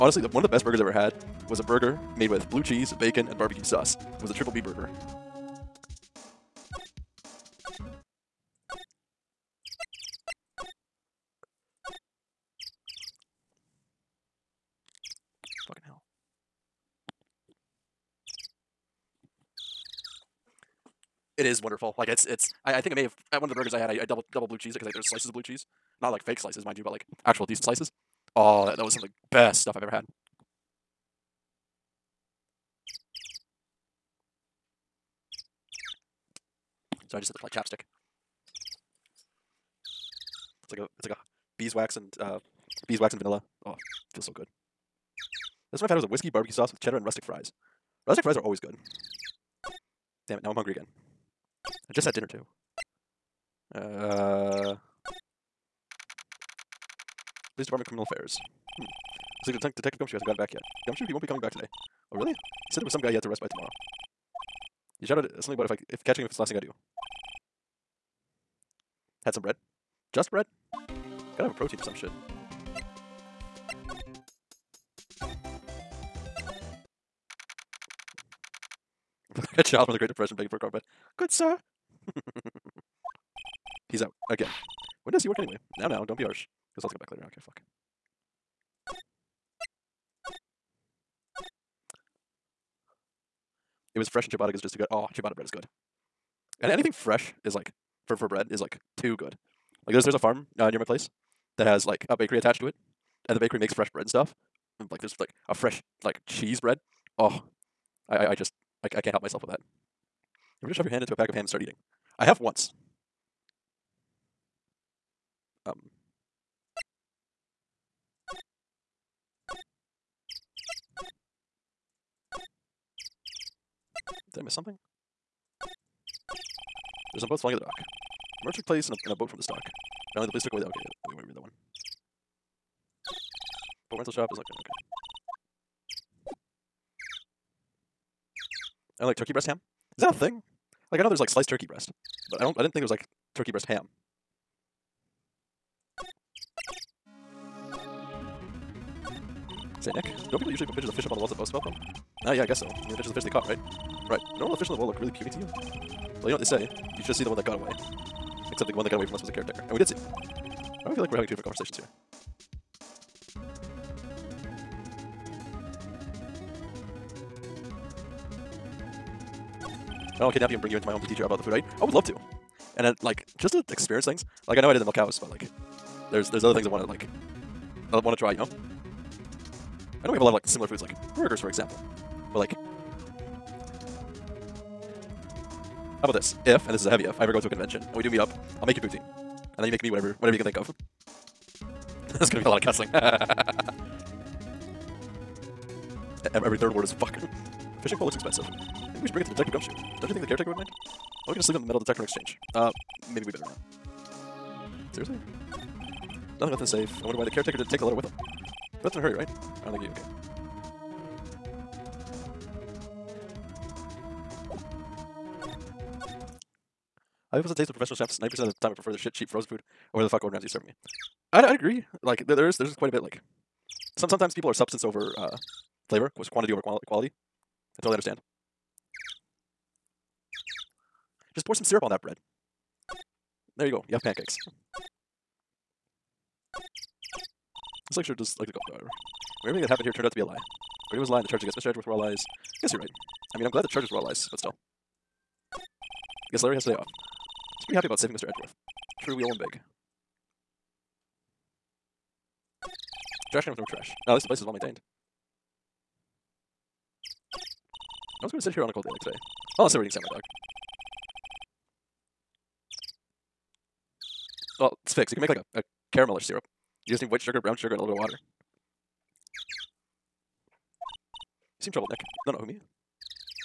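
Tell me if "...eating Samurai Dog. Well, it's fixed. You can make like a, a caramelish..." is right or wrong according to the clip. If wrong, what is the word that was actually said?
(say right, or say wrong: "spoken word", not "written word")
right.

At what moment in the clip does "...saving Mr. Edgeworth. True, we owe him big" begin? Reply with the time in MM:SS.
04:07.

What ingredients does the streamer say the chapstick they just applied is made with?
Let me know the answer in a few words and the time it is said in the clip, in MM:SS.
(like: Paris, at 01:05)
Beeswax and vanilla, at 00:42.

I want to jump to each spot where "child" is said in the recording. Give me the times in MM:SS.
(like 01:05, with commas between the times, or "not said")
01:19.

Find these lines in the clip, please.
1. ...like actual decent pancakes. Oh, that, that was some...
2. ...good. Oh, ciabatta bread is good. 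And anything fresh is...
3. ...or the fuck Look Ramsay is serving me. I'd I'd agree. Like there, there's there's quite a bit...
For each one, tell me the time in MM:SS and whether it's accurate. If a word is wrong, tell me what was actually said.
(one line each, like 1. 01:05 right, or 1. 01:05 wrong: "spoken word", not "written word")
1. 00:26 wrong: "slices", not "pancakes"
2. 01:34 right
3. 03:39 wrong: "Gordon", not "Look".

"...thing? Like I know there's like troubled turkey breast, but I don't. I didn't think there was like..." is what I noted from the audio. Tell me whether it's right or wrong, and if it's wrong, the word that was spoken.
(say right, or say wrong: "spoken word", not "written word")
wrong: "sliced", not "troubled".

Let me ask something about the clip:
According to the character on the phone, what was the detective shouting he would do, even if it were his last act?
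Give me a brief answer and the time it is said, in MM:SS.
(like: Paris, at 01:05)
Catching him, at 01:06.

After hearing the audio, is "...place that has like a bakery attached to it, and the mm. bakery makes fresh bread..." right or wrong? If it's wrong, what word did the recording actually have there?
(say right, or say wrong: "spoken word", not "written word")
right.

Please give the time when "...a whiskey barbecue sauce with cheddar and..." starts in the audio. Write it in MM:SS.
00:46.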